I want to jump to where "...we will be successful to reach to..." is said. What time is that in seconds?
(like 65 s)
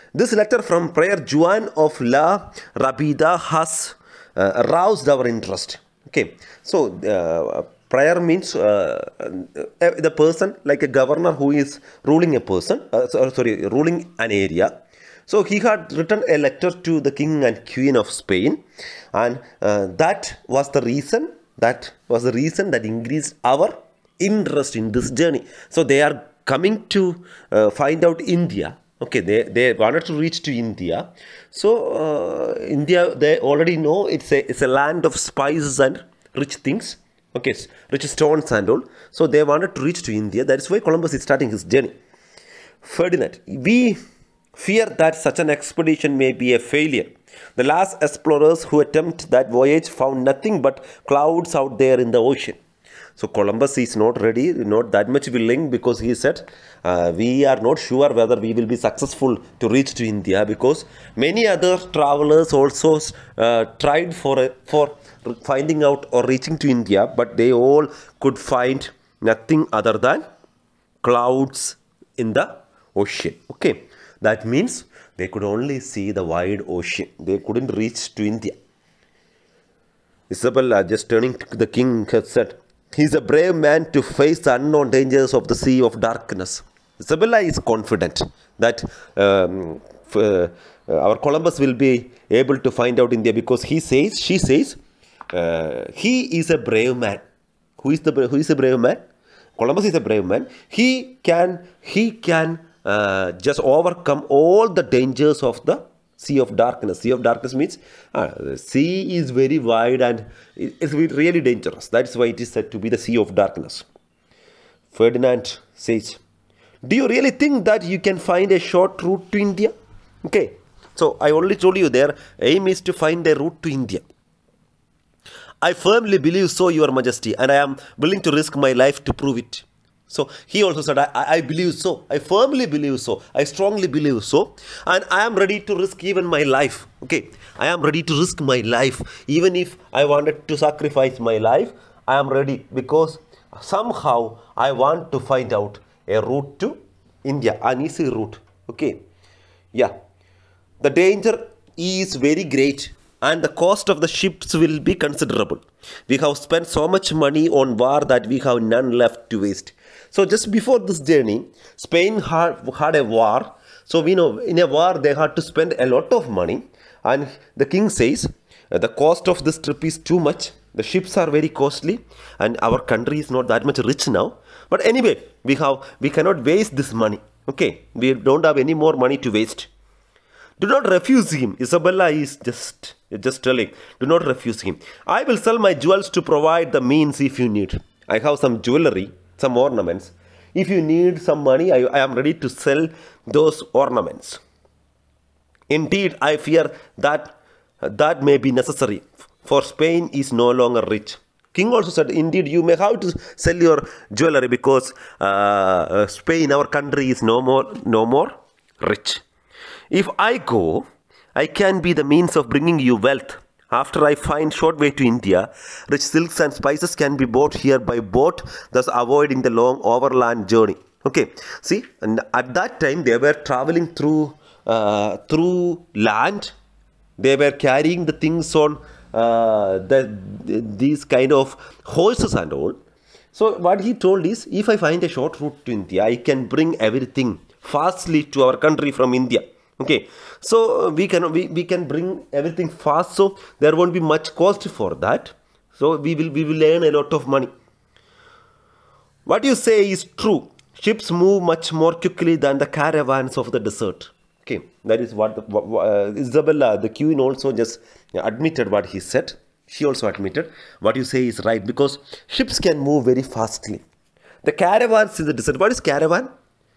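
58 s.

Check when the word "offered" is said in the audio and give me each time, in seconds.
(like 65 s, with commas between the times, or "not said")
not said.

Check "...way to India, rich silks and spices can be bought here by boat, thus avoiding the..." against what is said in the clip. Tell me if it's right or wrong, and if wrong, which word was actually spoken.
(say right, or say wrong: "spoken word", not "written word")
right.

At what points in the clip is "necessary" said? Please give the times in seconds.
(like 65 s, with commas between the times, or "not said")
198 s.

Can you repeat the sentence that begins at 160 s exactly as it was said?
So just before this journey, Spain had, had a war.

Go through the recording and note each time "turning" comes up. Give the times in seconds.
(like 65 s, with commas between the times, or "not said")
81 s.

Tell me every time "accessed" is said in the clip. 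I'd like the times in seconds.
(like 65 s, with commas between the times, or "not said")
not said.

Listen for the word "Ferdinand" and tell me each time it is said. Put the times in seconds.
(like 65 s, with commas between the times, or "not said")
42 s, 114 s.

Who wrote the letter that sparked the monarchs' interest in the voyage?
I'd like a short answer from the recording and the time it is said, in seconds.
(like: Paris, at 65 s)
Prayer Juan of La Rabida, at 0 s.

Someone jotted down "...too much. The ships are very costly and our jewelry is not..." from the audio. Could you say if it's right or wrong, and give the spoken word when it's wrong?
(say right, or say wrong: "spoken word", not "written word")
wrong: "country", not "jewelry".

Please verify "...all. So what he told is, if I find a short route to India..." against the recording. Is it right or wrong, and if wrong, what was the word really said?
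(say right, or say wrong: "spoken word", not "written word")
right.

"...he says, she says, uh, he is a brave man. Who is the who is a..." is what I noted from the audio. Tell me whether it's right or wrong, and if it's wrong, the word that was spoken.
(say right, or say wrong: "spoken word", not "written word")
right.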